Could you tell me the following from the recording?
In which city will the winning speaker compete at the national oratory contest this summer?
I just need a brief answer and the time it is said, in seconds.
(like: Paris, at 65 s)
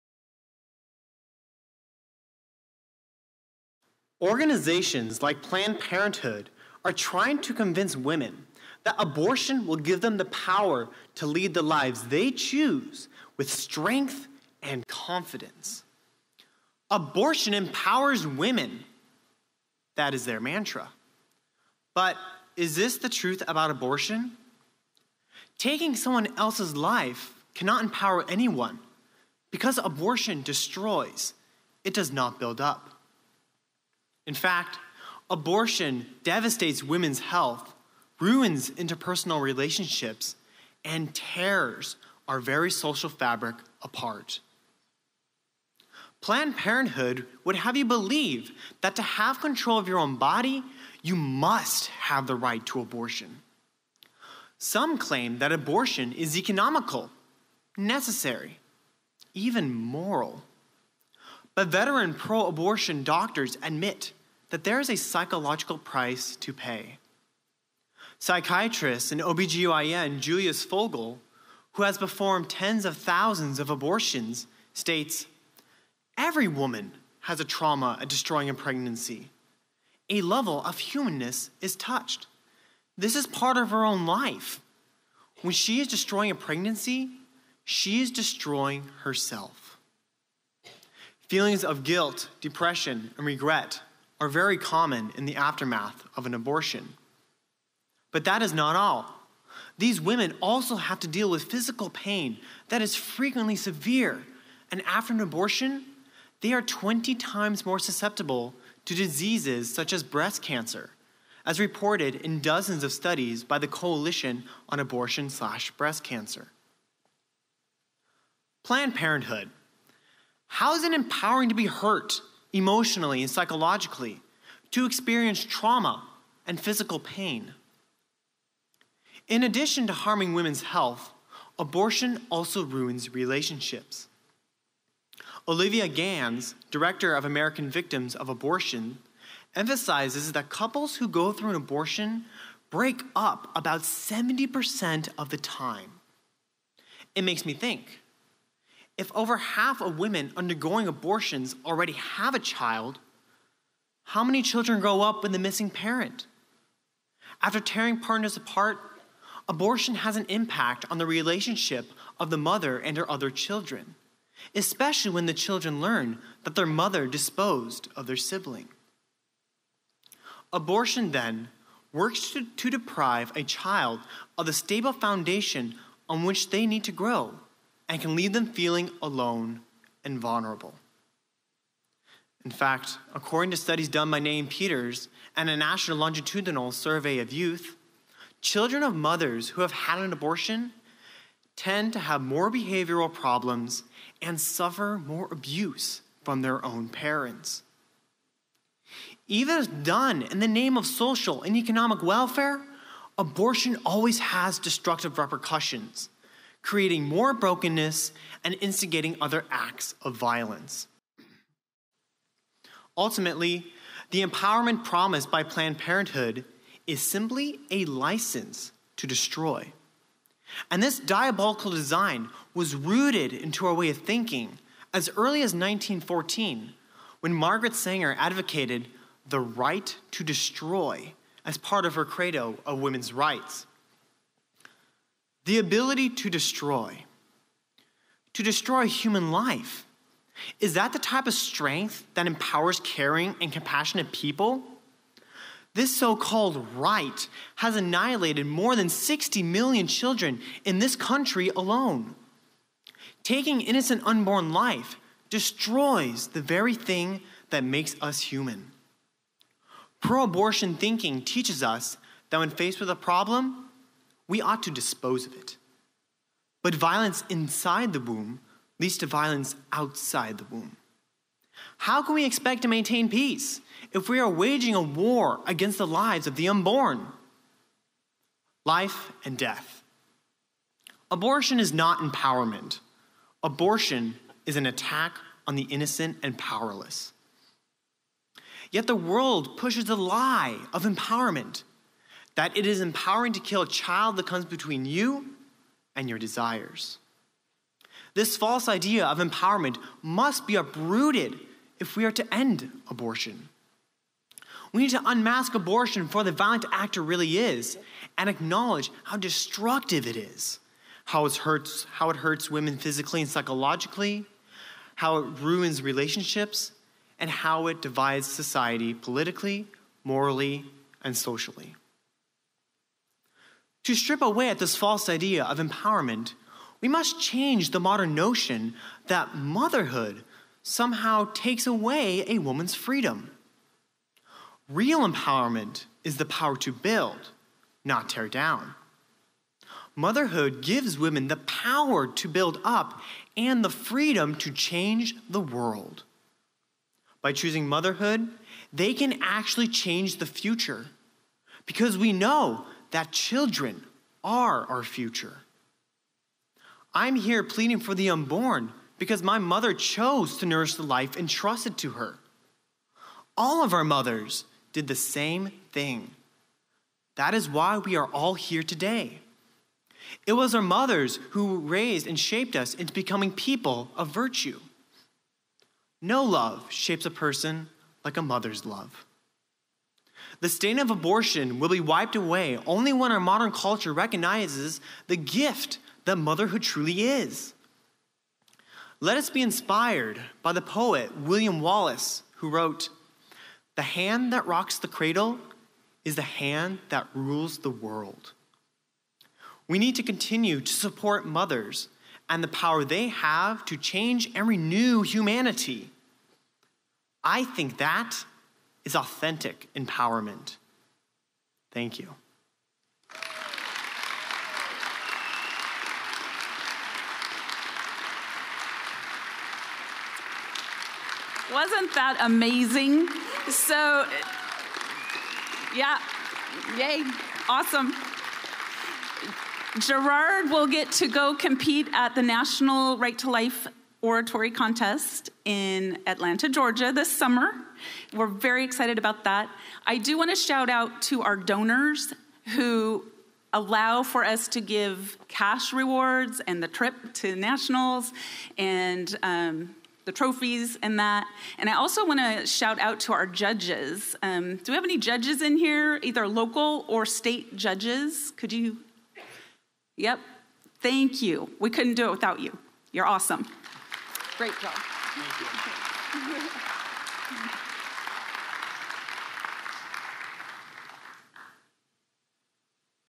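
Atlanta, at 436 s.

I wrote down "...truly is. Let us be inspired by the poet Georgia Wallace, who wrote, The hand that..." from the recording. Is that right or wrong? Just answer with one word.
wrong.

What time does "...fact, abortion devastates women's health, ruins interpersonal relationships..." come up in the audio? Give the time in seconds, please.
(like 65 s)
34 s.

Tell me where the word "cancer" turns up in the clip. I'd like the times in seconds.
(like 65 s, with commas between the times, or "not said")
110 s, 116 s.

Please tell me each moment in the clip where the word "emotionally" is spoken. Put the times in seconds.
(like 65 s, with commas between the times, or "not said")
122 s.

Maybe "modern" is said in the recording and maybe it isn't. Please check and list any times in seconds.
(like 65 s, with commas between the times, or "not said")
327 s, 383 s.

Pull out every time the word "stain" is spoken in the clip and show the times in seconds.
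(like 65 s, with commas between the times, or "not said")
380 s.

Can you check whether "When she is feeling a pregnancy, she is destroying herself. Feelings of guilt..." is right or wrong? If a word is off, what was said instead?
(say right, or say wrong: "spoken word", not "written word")
wrong: "destroying", not "feeling".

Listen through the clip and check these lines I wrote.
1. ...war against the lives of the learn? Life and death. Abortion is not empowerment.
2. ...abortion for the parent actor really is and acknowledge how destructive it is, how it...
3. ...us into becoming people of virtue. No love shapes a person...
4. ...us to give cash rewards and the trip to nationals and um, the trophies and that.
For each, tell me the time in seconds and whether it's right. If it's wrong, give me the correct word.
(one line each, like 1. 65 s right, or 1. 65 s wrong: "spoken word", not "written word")
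1. 274 s wrong: "unborn", not "learn"
2. 305 s wrong: "violent", not "parent"
3. 372 s right
4. 444 s right.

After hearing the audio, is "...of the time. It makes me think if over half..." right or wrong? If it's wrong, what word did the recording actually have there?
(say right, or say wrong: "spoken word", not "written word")
right.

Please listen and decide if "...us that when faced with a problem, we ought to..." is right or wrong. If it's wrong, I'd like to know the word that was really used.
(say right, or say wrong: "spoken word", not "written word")
right.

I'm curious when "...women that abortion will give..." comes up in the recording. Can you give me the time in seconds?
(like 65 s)
7 s.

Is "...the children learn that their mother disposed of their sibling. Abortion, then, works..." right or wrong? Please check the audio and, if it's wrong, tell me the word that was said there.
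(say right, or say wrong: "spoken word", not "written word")
right.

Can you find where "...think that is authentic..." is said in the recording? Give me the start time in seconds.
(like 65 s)
407 s.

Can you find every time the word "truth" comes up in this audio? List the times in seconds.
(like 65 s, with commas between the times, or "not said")
23 s.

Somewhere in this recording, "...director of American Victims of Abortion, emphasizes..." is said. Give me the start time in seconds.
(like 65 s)
136 s.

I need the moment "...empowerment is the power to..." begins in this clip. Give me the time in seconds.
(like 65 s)
335 s.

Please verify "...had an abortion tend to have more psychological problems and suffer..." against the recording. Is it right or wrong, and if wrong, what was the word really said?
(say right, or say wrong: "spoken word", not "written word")
wrong: "behavioral", not "psychological".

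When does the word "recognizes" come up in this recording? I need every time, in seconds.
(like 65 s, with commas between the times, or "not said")
383 s.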